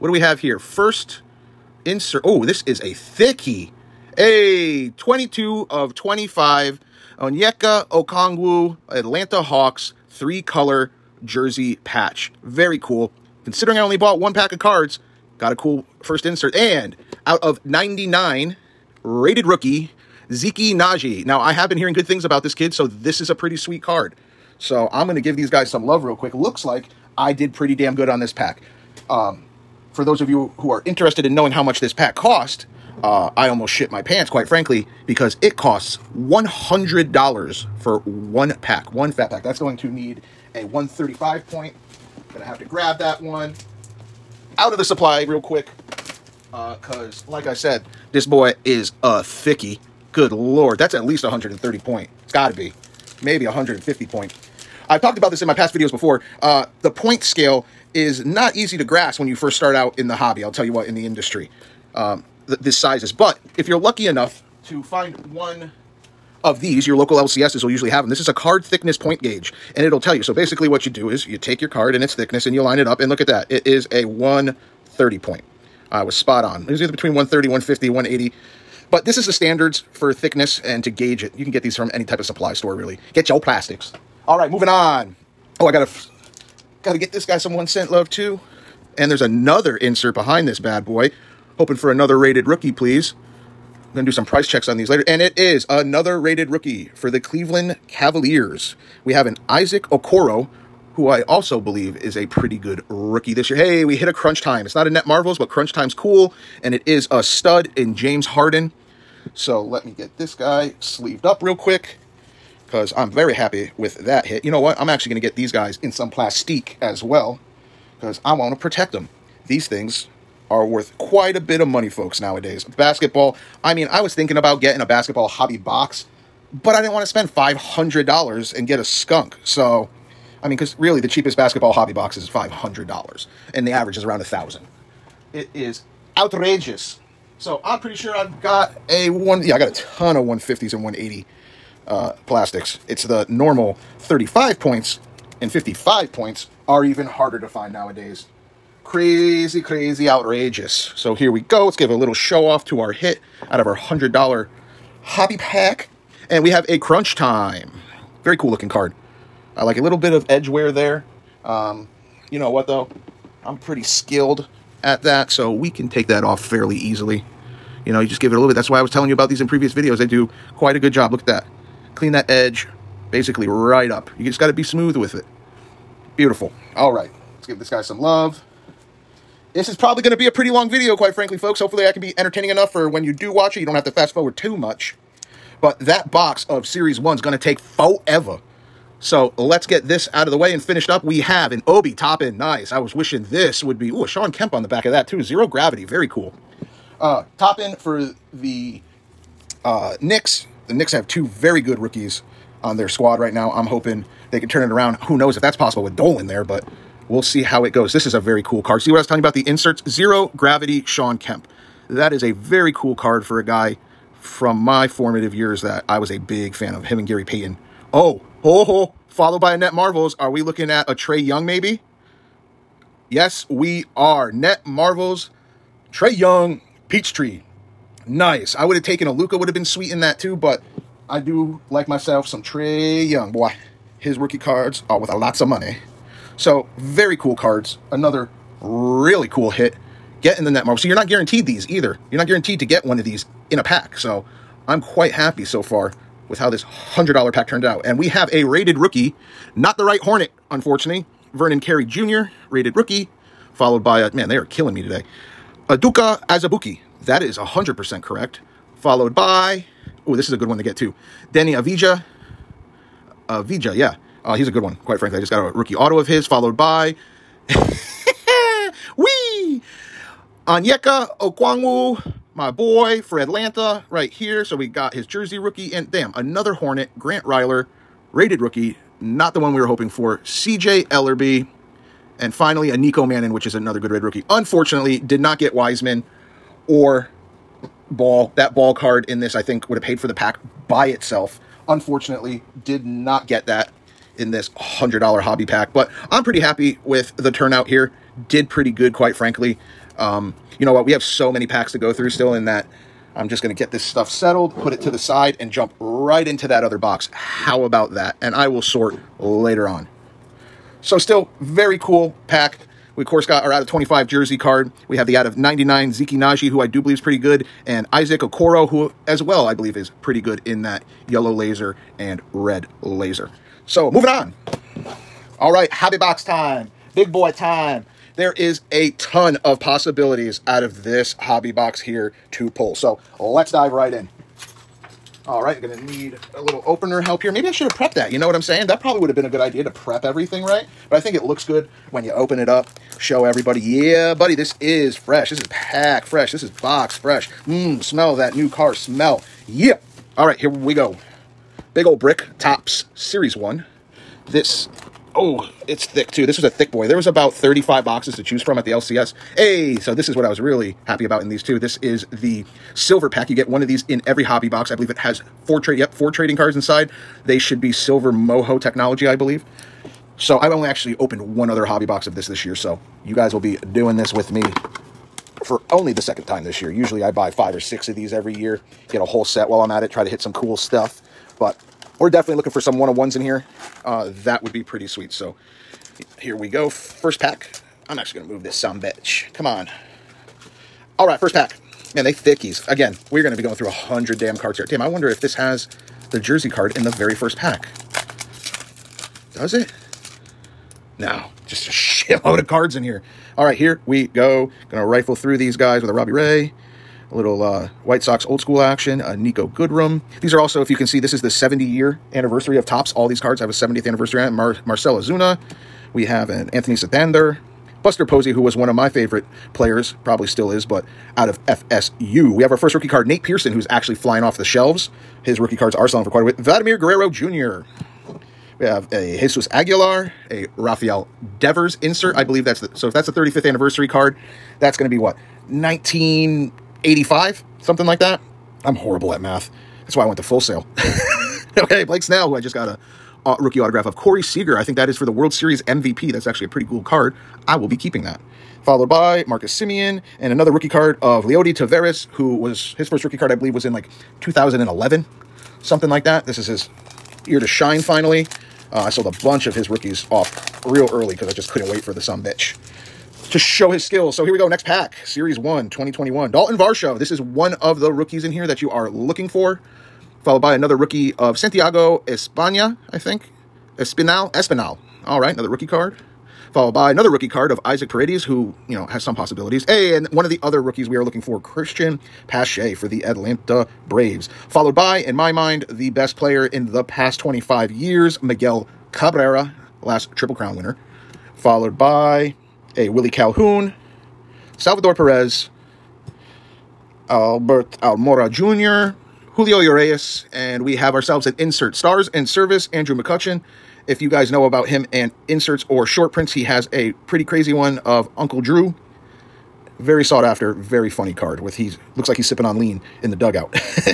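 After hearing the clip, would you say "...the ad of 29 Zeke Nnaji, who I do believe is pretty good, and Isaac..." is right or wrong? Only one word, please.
wrong.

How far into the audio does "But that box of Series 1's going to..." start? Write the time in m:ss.
3:05.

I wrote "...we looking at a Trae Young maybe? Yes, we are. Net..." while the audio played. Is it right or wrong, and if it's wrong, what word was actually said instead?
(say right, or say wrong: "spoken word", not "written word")
right.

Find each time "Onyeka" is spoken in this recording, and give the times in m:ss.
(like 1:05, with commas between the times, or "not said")
0:07, 4:30.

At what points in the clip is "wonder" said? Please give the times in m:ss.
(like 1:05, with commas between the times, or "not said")
6:34.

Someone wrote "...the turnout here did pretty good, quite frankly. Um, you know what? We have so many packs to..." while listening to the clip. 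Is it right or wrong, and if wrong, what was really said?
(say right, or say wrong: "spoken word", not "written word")
right.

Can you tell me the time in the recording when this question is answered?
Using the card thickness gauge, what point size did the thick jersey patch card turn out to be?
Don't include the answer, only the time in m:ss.
1:14.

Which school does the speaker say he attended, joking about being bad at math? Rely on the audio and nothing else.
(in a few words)
Full Sail.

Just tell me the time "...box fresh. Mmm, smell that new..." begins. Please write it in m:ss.
5:46.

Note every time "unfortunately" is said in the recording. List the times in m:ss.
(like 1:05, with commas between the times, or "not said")
4:10, 4:44, 4:51.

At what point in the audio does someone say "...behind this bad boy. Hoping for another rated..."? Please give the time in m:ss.
1:30.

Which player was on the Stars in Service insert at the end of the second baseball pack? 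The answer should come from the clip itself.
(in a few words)
Andrew McCutchen.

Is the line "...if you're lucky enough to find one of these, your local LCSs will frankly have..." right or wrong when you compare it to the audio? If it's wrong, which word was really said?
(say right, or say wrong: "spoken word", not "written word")
wrong: "usually", not "frankly".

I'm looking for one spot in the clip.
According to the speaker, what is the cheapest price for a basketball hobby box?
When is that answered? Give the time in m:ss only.
2:12.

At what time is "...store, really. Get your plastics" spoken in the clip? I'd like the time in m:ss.
1:22.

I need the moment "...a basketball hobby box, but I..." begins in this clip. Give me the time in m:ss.
2:04.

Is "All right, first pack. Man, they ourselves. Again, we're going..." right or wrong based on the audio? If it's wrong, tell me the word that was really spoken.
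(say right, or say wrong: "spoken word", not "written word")
wrong: "thickies", not "ourselves".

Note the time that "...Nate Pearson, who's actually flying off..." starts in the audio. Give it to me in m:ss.
7:03.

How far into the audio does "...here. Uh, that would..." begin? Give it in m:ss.
6:23.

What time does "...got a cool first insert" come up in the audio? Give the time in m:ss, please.
0:15.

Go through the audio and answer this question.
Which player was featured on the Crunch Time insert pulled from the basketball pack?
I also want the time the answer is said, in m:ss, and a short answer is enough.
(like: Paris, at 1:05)
James Harden, at 1:47.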